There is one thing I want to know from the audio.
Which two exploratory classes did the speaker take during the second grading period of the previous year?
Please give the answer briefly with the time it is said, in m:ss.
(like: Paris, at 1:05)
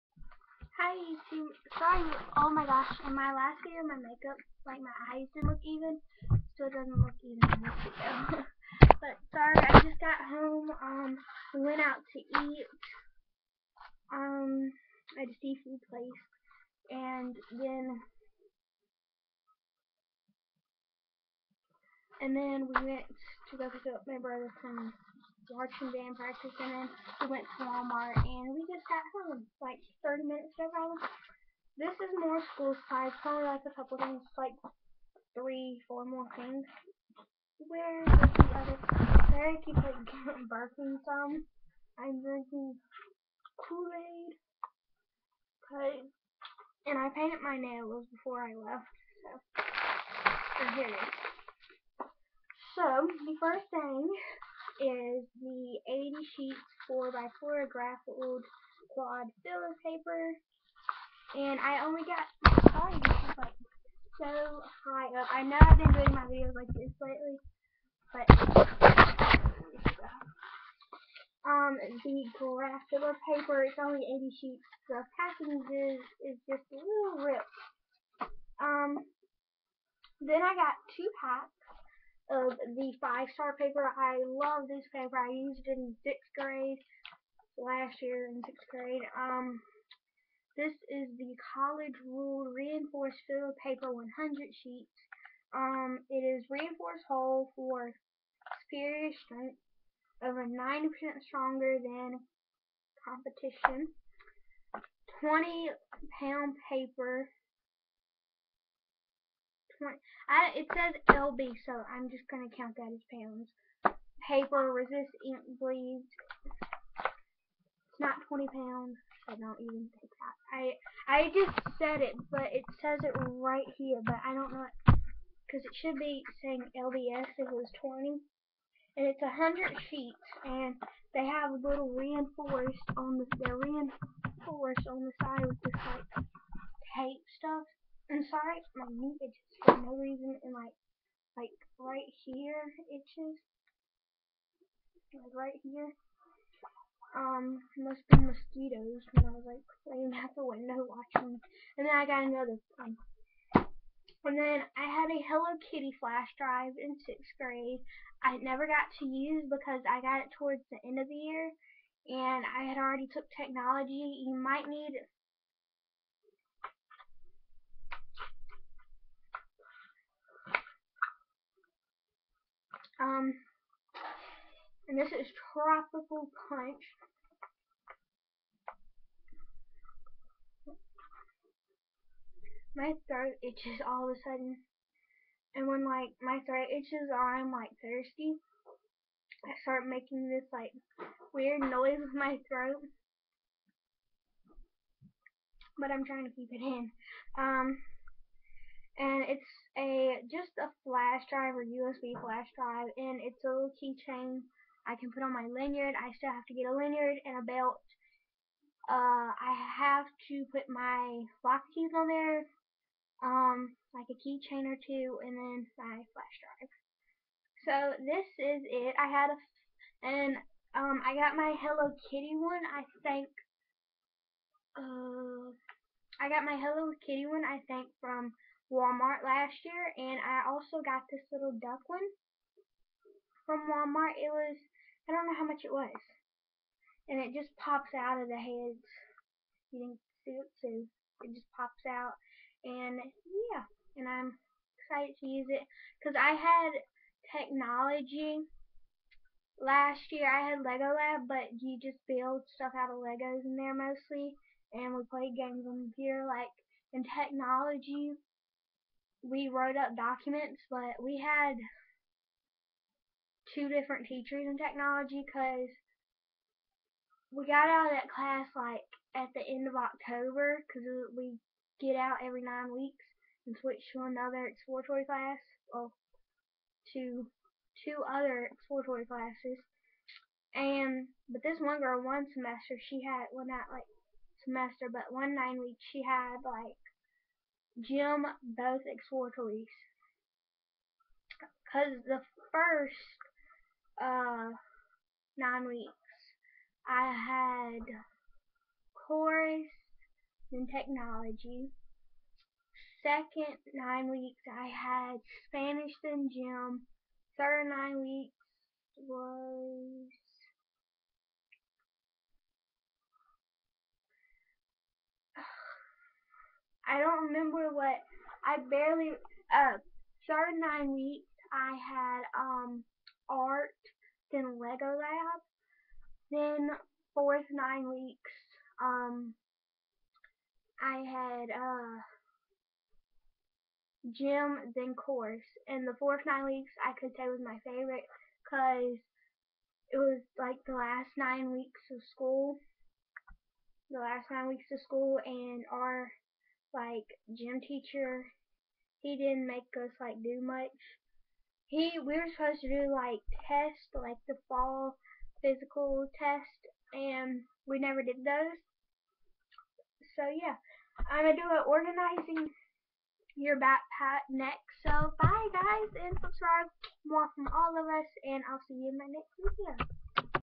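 Spanish and gym, at 5:05.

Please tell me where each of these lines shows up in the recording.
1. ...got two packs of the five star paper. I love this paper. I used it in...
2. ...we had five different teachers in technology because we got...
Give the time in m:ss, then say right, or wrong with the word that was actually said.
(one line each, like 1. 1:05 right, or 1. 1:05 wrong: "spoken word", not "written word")
1. 1:20 right
2. 4:21 wrong: "two", not "five".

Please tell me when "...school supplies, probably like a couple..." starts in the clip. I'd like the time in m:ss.
0:32.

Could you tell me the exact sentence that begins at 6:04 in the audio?
So bye guys, and subscribe more from all of us, and I'll see you in my next video.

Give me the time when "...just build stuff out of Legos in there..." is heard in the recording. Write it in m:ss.
4:11.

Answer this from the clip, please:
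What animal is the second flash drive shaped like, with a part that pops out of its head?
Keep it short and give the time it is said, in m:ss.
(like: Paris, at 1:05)
Duck, at 3:51.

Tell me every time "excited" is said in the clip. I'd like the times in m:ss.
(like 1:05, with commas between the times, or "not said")
4:04.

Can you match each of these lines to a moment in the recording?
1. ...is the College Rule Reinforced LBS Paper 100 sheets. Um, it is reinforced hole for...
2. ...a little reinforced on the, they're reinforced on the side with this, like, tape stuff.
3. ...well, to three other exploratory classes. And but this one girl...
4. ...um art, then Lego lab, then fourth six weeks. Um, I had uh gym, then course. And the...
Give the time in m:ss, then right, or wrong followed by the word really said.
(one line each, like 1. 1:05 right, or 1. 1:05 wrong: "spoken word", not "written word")
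1. 1:30 wrong: "Fill", not "LBS"
2. 2:11 right
3. 4:35 wrong: "two", not "three"
4. 5:22 wrong: "nine", not "six".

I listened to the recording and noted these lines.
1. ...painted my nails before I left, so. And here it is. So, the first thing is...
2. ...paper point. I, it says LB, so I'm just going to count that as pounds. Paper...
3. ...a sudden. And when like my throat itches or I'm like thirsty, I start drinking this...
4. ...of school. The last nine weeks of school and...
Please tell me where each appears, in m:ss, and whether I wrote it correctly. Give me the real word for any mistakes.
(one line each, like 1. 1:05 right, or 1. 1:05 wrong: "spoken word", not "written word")
1. 0:47 right
2. 1:46 right
3. 3:04 wrong: "making", not "drinking"
4. 5:41 right.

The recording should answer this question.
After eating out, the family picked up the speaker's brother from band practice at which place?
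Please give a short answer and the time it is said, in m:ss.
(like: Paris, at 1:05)
Georgetown, at 0:25.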